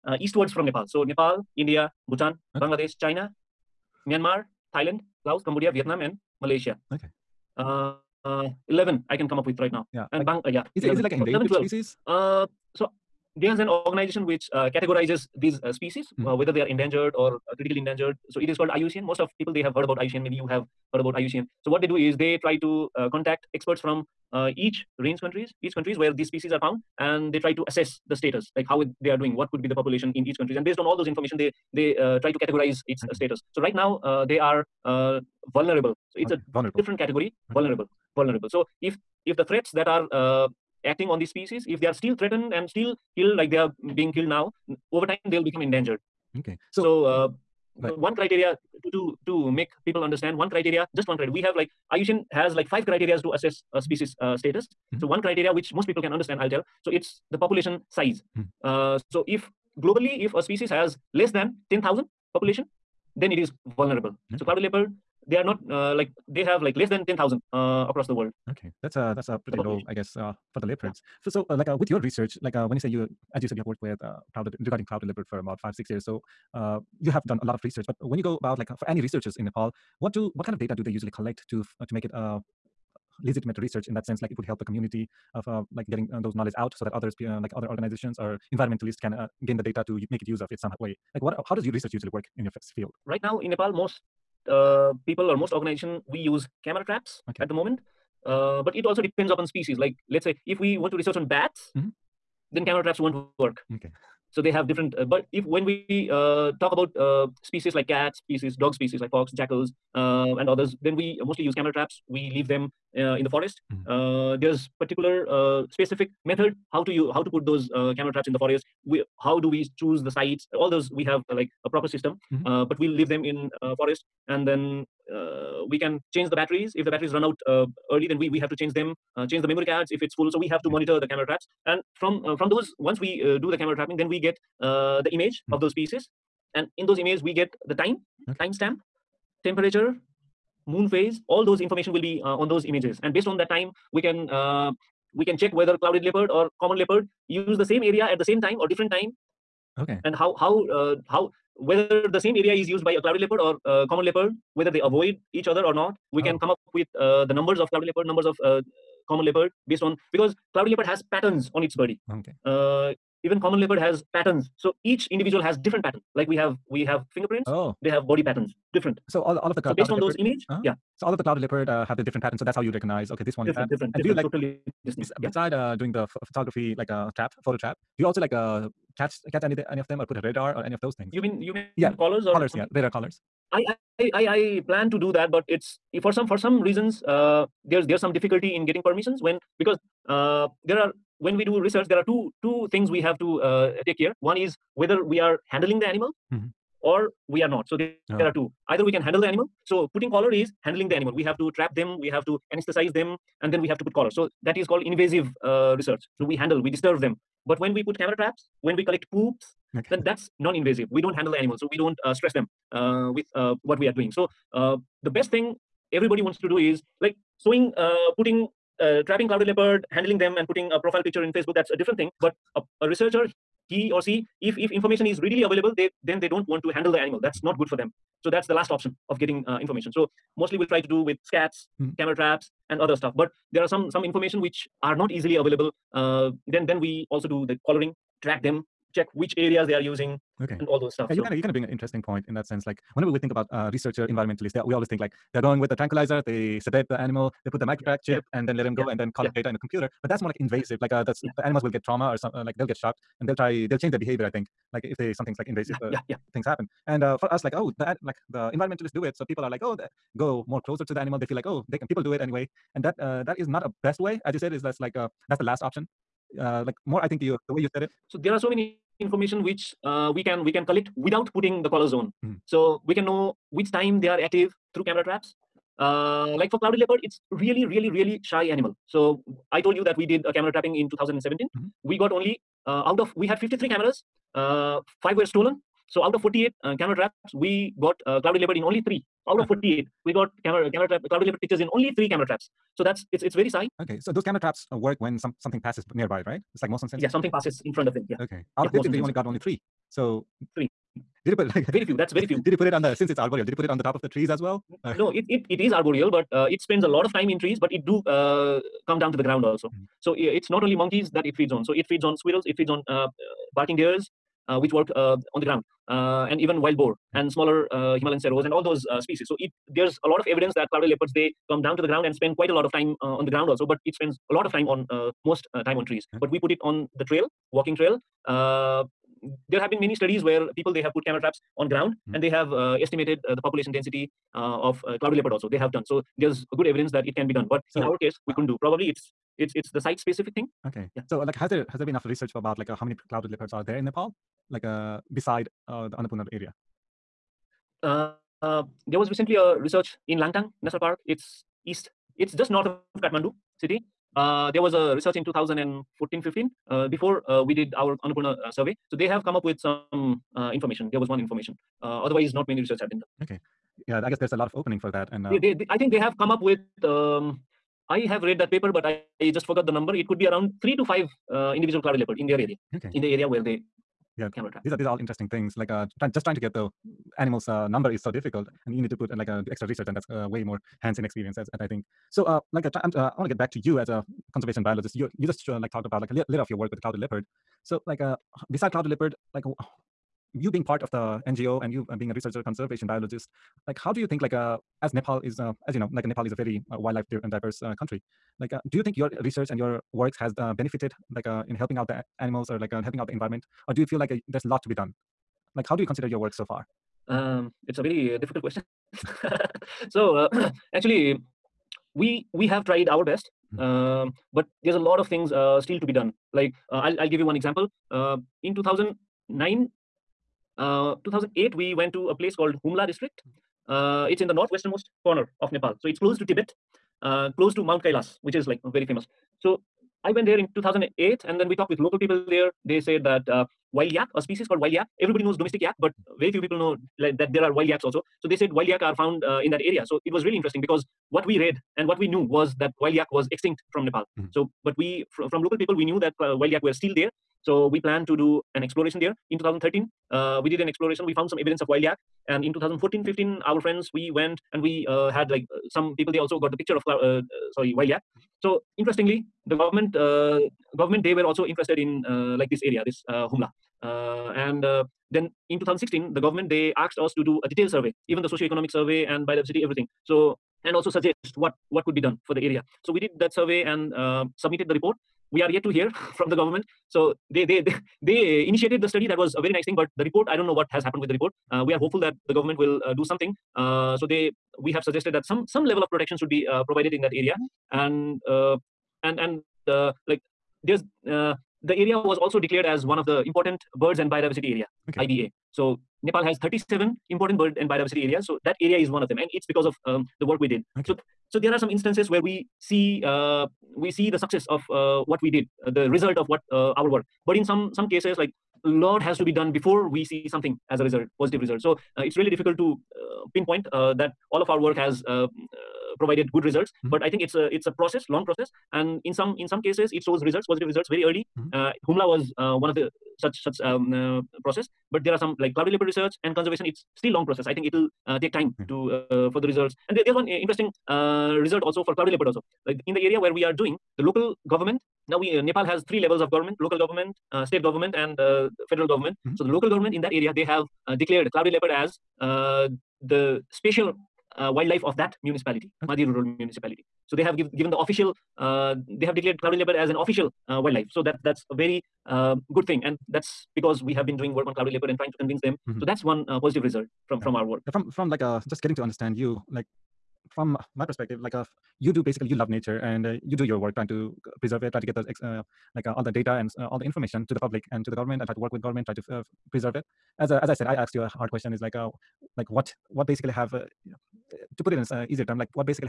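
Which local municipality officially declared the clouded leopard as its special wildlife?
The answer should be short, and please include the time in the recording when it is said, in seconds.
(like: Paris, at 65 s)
Madi Rural Municipality, at 545 s.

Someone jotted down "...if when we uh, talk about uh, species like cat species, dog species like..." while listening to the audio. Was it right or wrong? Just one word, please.
right.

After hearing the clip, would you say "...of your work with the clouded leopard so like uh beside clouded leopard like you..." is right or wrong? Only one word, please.
right.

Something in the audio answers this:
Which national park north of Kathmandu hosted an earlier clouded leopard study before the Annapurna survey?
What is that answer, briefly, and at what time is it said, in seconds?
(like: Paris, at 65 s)
Langtang National Park, at 350 s.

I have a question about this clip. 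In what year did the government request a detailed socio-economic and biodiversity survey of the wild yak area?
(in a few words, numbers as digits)
2016.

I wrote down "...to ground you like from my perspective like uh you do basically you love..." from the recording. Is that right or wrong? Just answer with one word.
wrong.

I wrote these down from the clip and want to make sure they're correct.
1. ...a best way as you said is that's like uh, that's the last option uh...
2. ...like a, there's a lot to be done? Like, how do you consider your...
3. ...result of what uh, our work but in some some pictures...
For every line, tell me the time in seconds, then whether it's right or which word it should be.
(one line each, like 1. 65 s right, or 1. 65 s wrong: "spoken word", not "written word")
1. 263 s right
2. 403 s right
3. 505 s wrong: "cases", not "pictures".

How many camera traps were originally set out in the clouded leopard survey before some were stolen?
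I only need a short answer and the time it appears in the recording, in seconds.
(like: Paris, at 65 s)
53, at 283 s.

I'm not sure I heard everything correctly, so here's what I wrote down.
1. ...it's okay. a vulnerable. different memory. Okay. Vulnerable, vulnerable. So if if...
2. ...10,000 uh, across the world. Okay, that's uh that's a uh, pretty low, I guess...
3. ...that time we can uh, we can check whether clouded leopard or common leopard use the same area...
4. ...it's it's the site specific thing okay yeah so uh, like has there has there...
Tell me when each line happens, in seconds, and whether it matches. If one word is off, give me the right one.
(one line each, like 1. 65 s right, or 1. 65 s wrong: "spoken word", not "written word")
1. 36 s wrong: "category", not "memory"
2. 67 s right
3. 143 s right
4. 339 s right.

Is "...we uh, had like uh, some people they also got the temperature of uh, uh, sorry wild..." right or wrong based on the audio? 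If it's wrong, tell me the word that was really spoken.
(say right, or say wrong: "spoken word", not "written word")
wrong: "picture", not "temperature".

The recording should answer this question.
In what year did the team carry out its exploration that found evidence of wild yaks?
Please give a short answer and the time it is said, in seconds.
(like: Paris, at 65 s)
2013, at 449 s.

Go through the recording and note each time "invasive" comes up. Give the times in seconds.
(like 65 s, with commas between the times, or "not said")
204 s, 210 s, 250 s, 255 s.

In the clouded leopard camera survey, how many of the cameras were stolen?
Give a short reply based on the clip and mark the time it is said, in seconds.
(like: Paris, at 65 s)
5, at 285 s.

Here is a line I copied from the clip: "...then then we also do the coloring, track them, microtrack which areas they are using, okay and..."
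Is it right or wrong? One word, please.
wrong.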